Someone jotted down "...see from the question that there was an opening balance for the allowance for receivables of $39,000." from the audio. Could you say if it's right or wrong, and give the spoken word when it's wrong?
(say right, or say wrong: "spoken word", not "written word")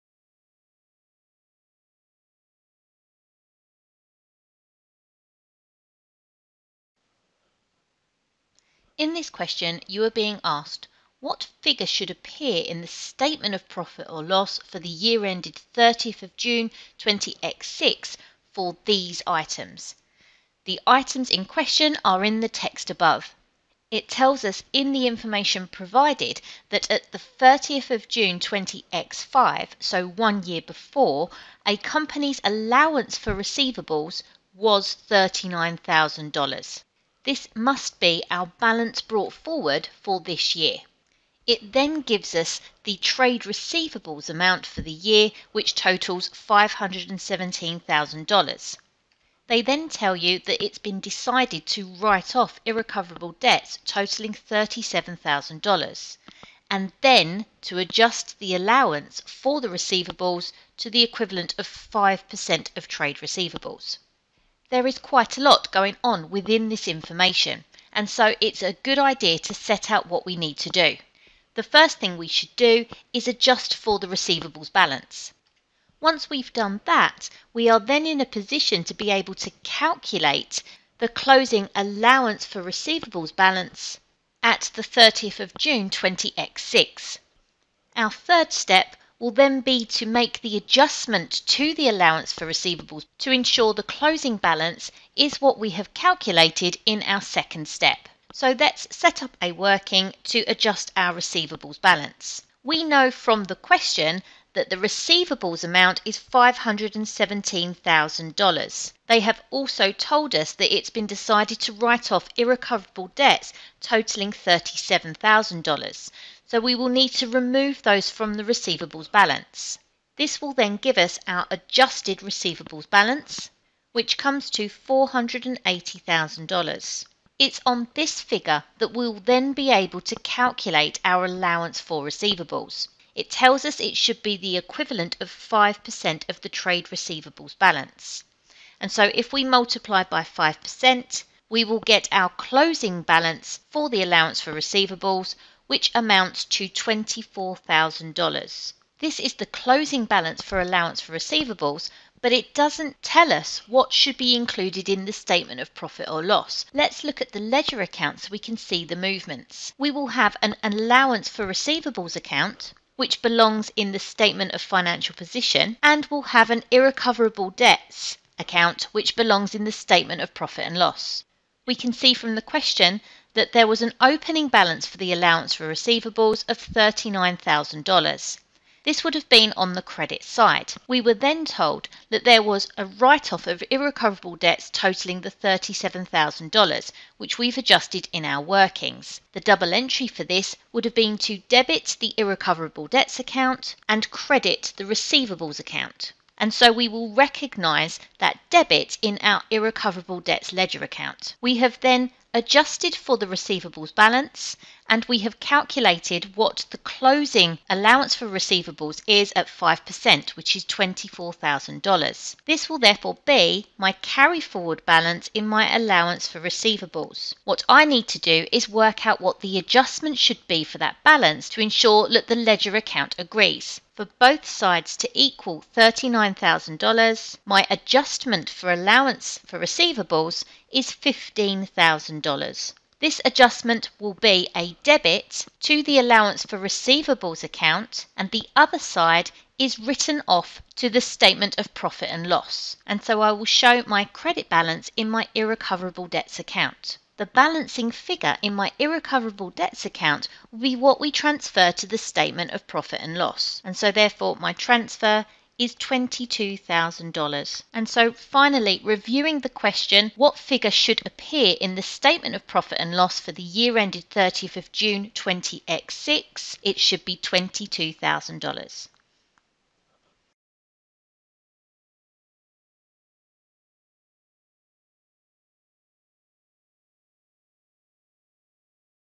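right.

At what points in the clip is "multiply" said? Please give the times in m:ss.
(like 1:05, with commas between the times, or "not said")
2:19.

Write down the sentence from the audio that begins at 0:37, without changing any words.
This must be our balance brought forward for this year.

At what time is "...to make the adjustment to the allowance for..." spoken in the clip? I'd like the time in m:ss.
1:29.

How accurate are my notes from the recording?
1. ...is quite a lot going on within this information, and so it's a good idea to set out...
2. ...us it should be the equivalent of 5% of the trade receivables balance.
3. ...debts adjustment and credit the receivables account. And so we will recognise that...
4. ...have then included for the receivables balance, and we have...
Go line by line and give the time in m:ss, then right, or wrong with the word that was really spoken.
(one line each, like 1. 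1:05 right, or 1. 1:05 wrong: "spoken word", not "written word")
1. 1:04 right
2. 2:13 right
3. 3:12 wrong: "account", not "adjustment"
4. 3:21 wrong: "adjusted", not "included".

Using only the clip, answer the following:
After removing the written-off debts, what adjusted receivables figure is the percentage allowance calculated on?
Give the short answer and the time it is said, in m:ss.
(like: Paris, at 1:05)
$480,000, at 2:04.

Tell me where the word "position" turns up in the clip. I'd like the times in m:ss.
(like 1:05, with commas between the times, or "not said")
1:18, 2:45.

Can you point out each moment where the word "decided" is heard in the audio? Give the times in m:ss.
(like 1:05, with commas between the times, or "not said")
0:50, 1:51.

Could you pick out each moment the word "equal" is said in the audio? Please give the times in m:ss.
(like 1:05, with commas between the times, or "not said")
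3:45.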